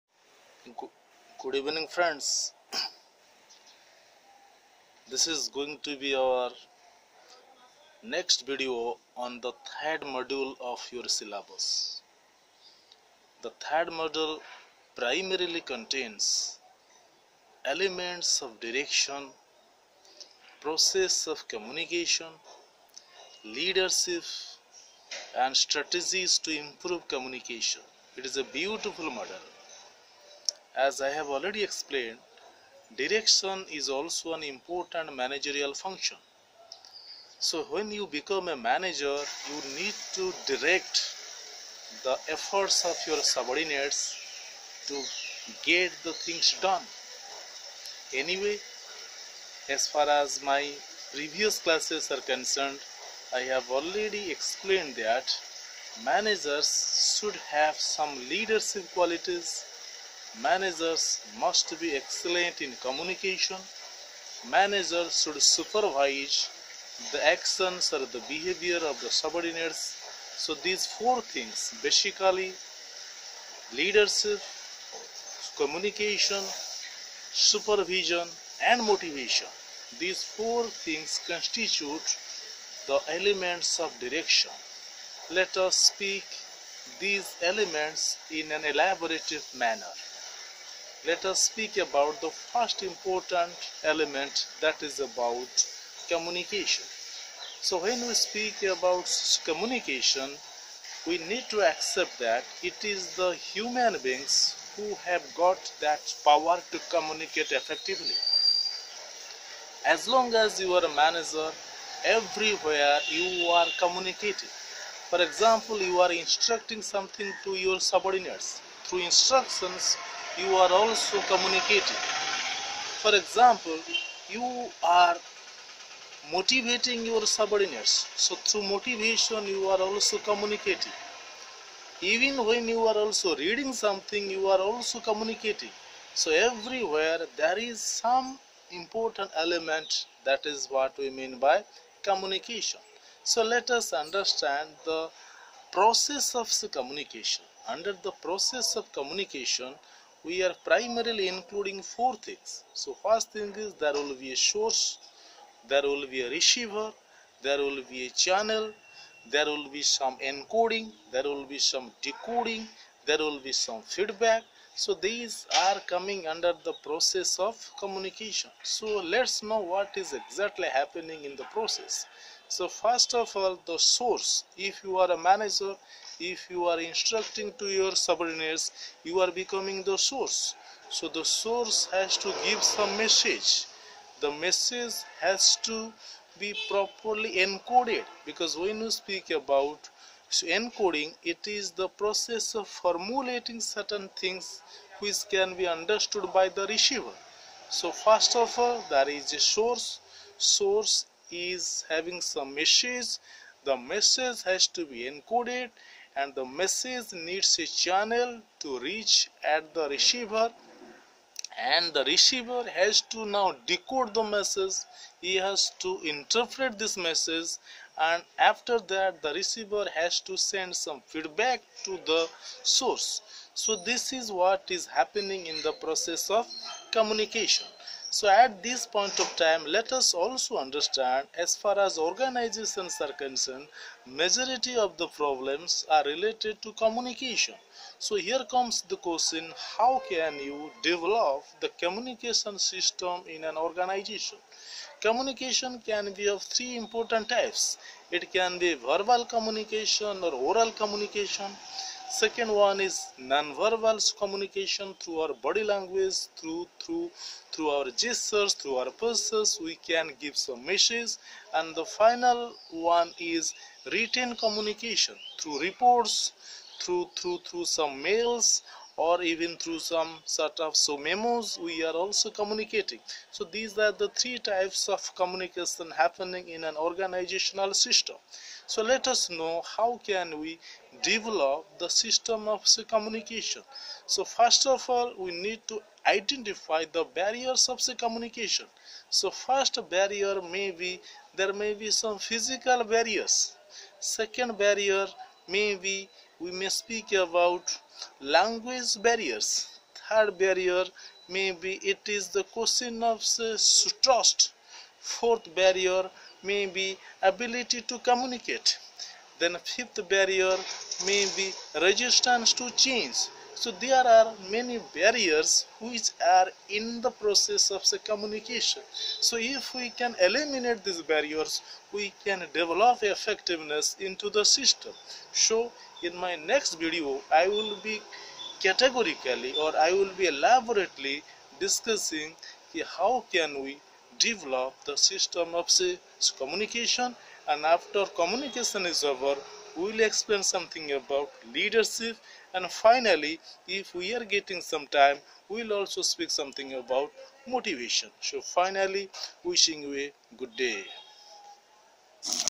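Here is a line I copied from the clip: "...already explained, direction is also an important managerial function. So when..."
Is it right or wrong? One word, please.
right.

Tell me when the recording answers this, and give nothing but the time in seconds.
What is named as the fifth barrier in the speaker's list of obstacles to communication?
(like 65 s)
311 s.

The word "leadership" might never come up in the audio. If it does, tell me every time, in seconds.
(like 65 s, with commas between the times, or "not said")
23 s, 58 s, 73 s, 341 s.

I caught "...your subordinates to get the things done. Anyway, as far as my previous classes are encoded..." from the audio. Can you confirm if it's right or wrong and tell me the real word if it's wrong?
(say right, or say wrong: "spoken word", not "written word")
wrong: "concerned", not "encoded".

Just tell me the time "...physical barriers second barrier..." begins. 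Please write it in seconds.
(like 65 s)
292 s.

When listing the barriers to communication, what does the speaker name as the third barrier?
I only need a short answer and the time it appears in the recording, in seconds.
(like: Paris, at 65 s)
Trust, at 302 s.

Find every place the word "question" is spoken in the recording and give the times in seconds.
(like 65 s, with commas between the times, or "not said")
238 s, 302 s.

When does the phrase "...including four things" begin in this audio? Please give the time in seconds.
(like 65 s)
151 s.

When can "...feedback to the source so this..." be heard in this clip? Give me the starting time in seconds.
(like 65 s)
221 s.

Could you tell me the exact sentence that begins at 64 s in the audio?
Managers should supervise the actions or the behavior of the subordinates.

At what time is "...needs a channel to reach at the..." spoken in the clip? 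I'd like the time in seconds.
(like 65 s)
207 s.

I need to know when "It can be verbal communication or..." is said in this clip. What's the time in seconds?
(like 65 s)
248 s.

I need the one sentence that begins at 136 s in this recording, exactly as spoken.
So everywhere there is some important element that is what we mean by communication.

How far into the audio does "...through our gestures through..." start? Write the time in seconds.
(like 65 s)
257 s.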